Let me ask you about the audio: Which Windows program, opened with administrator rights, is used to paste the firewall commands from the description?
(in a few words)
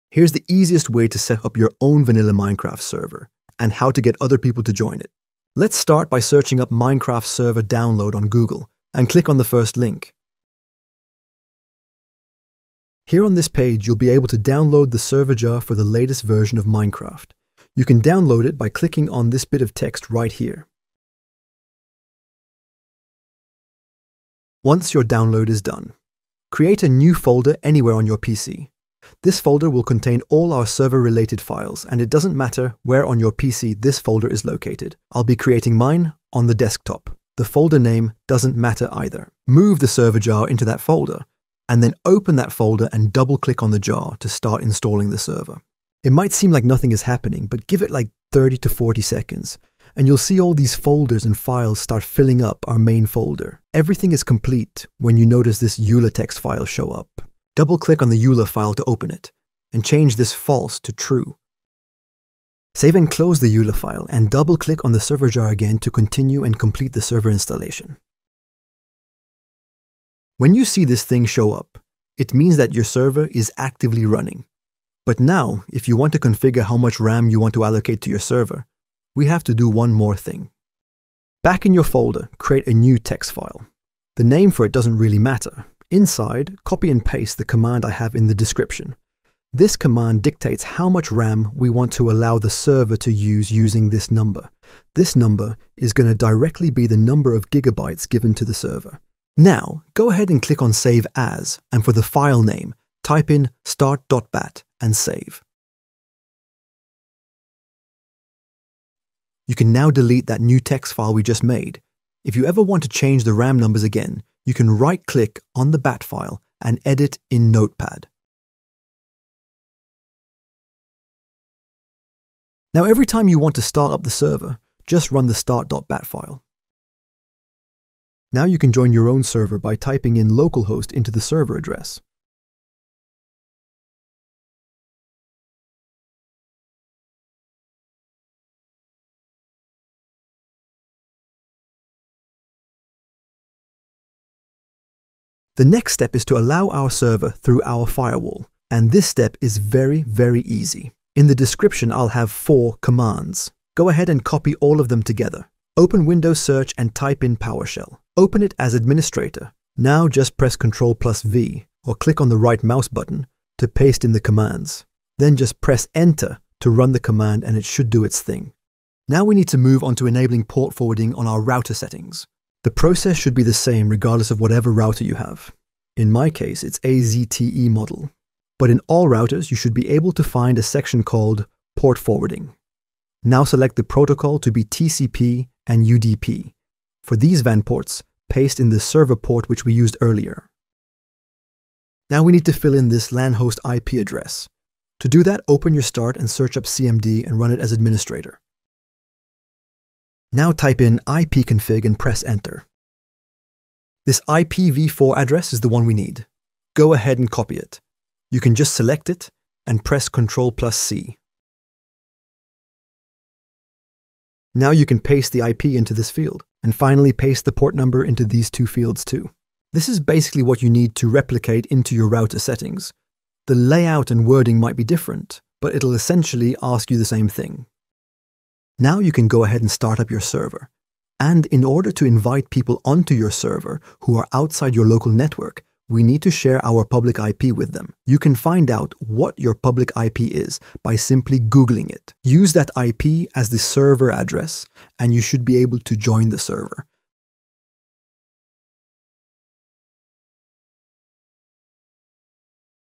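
PowerShell.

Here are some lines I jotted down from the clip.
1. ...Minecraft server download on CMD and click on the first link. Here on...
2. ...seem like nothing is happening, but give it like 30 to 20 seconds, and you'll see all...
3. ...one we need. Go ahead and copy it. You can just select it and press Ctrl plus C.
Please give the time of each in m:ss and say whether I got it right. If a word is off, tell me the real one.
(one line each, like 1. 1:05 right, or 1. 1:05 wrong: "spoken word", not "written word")
1. 0:06 wrong: "Google", not "CMD"
2. 0:46 wrong: "40", not "20"
3. 3:25 right.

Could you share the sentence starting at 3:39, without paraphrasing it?
This is basically what you need to replicate into your router settings.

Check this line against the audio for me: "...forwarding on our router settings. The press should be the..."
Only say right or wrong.
wrong.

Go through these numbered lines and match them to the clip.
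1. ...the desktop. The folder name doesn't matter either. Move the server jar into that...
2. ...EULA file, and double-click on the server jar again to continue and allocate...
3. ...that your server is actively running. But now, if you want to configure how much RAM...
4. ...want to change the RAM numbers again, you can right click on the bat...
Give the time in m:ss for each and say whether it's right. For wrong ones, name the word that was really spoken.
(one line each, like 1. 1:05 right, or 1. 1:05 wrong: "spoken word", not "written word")
1. 0:36 right
2. 1:03 wrong: "complete", not "allocate"
3. 1:12 right
4. 1:52 right.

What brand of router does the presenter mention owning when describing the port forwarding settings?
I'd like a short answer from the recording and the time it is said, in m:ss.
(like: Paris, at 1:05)
ZTE, at 2:56.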